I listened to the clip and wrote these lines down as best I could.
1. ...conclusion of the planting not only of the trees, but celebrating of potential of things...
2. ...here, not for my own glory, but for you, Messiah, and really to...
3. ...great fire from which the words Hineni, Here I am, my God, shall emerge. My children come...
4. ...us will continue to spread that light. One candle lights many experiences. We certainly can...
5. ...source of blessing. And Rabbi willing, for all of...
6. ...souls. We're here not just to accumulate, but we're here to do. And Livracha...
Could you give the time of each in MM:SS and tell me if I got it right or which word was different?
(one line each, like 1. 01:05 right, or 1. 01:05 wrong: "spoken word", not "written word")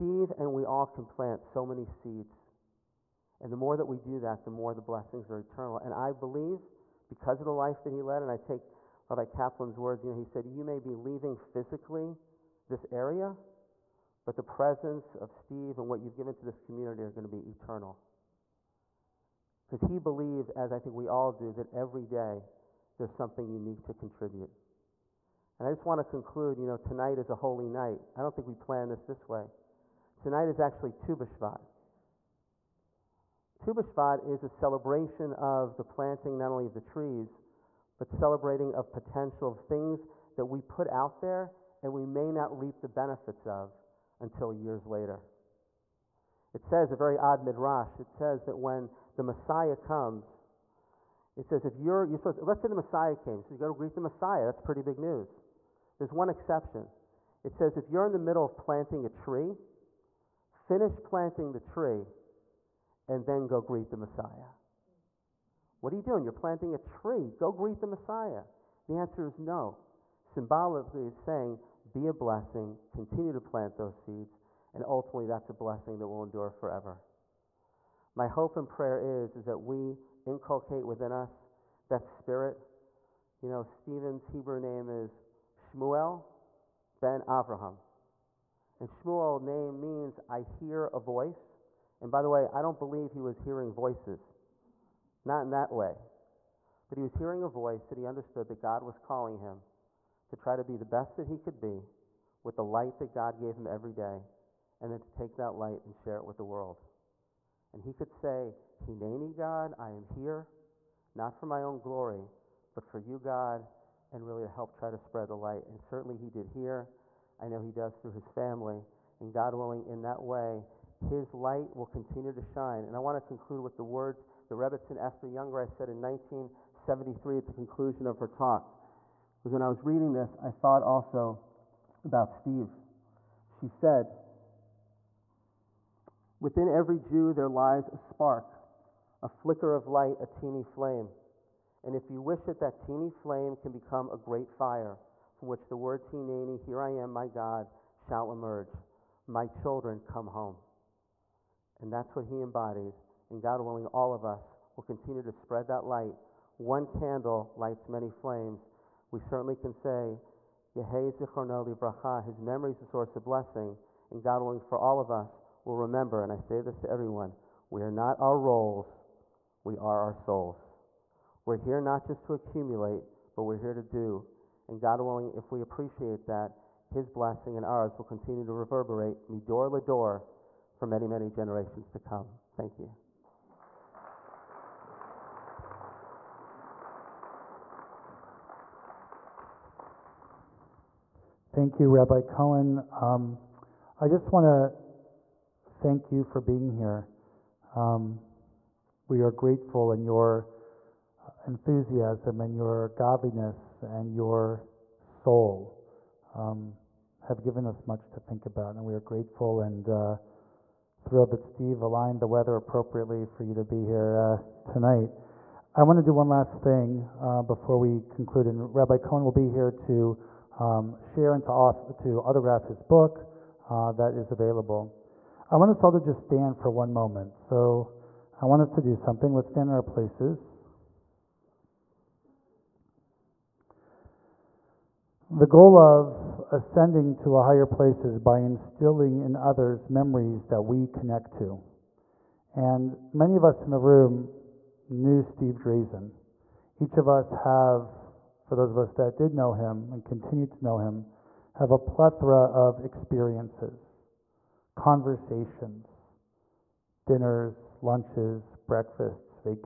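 1. 00:34 wrong: "celebration", not "conclusion"
2. 01:50 wrong: "God", not "Messiah"
3. 02:24 right
4. 02:34 wrong: "flames", not "experiences"
5. 02:42 wrong: "God", not "Rabbi"
6. 02:50 wrong: "God", not "Livracha".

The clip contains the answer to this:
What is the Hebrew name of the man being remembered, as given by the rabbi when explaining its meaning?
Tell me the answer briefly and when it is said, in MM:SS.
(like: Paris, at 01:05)
Shmuel ben Avraham, at 01:25.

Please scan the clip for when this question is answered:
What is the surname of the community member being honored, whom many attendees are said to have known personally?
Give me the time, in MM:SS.
04:05.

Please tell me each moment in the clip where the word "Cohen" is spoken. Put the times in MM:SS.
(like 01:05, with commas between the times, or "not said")
03:12, 03:38.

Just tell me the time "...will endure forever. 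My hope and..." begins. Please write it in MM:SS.
01:16.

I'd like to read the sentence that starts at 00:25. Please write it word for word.
And I just want to conclude you know, tonight is a holy night.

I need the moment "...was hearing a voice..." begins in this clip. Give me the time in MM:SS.
01:37.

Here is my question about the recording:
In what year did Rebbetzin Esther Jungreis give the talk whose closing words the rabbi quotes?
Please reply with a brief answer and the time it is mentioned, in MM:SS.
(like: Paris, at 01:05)
1973, at 02:06.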